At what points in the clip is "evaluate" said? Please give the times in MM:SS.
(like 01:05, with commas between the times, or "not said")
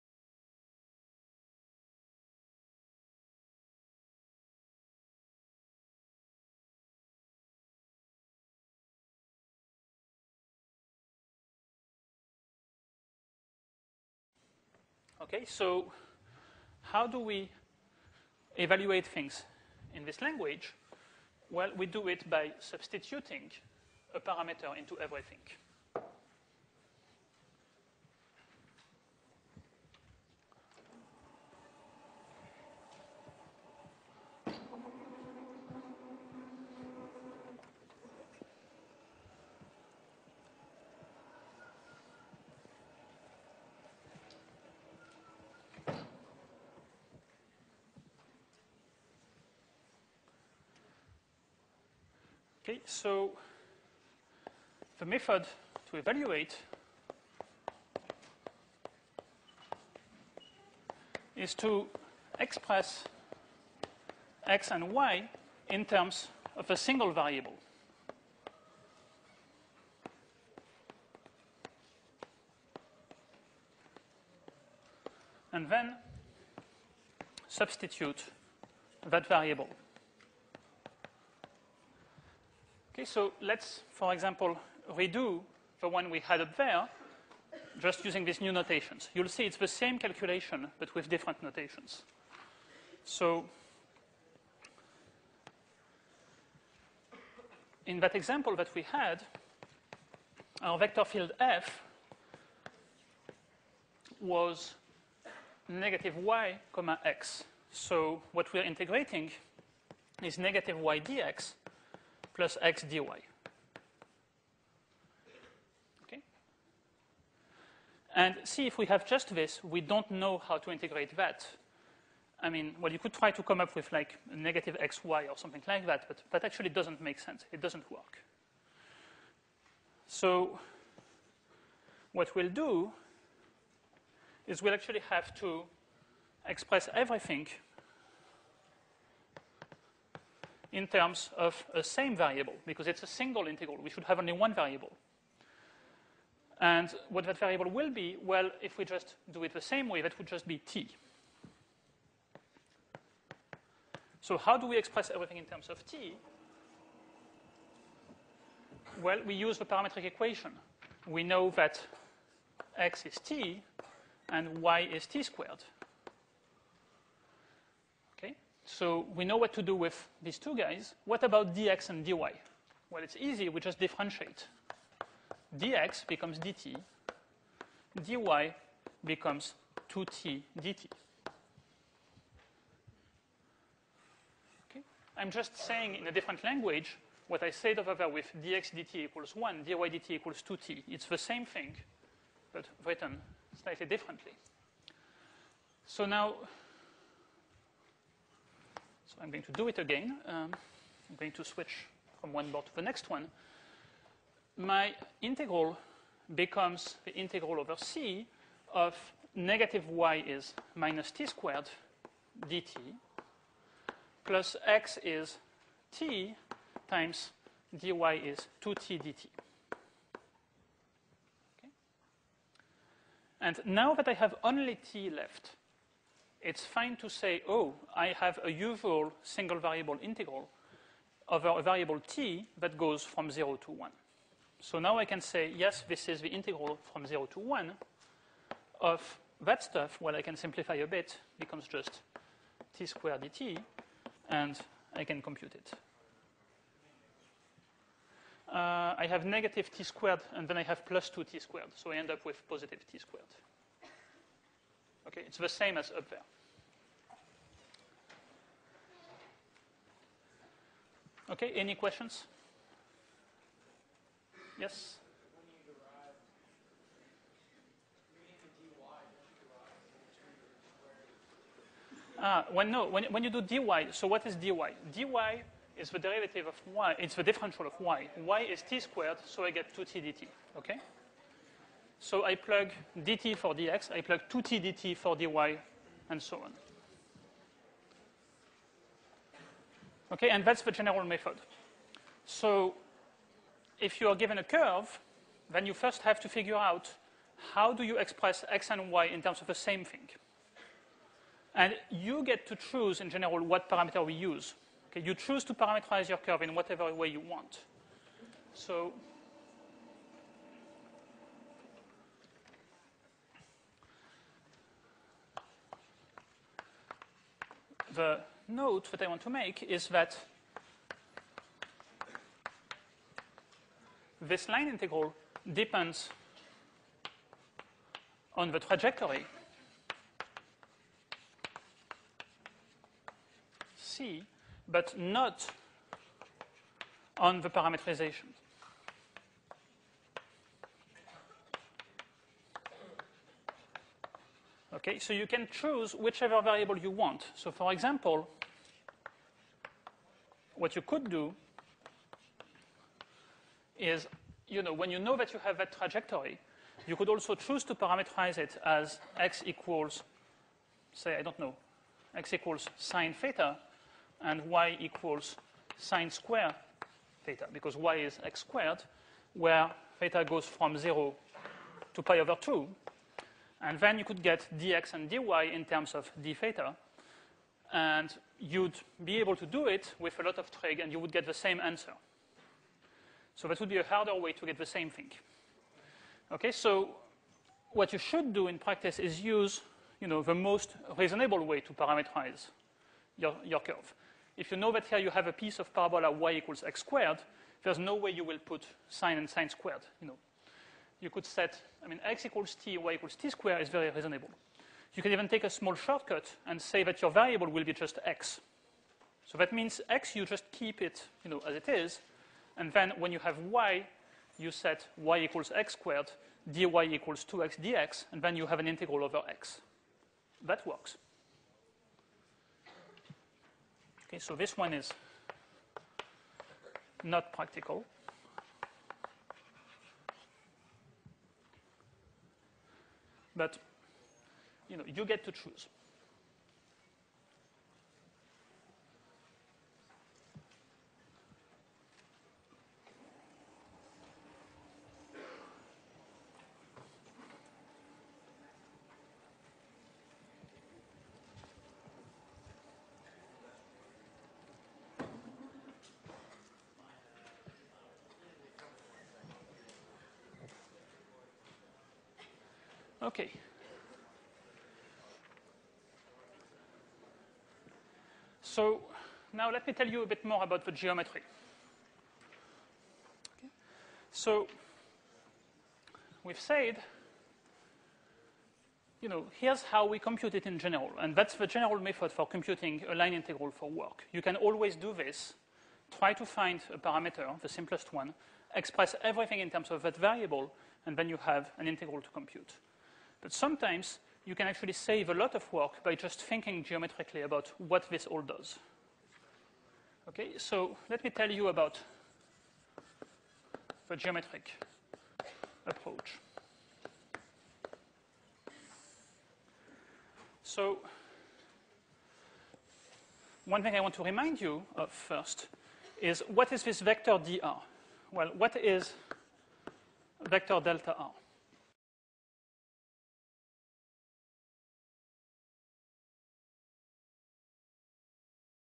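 00:18, 00:55.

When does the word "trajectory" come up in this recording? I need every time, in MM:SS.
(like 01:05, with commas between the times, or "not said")
05:28, 05:55.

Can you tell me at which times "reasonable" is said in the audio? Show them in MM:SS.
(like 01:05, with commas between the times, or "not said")
06:30, 06:43.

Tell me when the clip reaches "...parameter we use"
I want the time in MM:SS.
05:03.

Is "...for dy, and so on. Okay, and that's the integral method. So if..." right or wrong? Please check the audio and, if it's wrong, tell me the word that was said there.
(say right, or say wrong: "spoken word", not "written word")
wrong: "general", not "integral".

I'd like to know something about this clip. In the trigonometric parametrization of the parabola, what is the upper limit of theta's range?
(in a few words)
pi over 2.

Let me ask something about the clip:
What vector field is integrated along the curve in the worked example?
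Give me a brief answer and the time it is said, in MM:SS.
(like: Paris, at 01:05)
negative y comma x, at 01:45.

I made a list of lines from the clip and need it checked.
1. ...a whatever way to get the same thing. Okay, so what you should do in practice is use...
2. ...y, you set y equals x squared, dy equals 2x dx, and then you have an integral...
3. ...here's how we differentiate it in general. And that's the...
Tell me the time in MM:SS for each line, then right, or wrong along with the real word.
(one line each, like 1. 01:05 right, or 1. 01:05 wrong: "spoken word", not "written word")
1. 06:23 wrong: "harder", not "whatever"
2. 06:53 right
3. 07:59 wrong: "compute", not "differentiate".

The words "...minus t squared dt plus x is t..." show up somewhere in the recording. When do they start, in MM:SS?
03:30.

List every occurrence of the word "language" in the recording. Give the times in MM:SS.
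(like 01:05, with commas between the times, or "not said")
00:20, 03:06.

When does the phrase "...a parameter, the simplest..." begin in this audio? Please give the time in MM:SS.
08:06.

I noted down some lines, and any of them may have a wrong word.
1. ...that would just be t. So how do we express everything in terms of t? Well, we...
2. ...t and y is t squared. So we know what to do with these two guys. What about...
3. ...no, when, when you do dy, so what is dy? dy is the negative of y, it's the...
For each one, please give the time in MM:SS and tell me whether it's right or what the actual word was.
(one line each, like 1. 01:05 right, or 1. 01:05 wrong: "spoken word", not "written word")
1. 02:30 right
2. 02:43 right
3. 04:32 wrong: "derivative", not "negative".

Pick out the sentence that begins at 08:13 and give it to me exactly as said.
But sometimes you can actually save a lot of work by just thinking geometrically about what this all does.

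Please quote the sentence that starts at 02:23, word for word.
We should have only one variable.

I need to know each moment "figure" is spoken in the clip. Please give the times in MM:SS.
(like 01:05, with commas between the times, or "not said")
04:56.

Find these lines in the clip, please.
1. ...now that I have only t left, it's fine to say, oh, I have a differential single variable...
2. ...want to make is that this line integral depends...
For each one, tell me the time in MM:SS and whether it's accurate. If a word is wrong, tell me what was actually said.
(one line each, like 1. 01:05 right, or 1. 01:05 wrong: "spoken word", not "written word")
1. 03:43 wrong: "usual", not "differential"
2. 05:19 right.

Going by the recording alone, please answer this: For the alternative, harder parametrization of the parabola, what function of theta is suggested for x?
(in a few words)
sine theta.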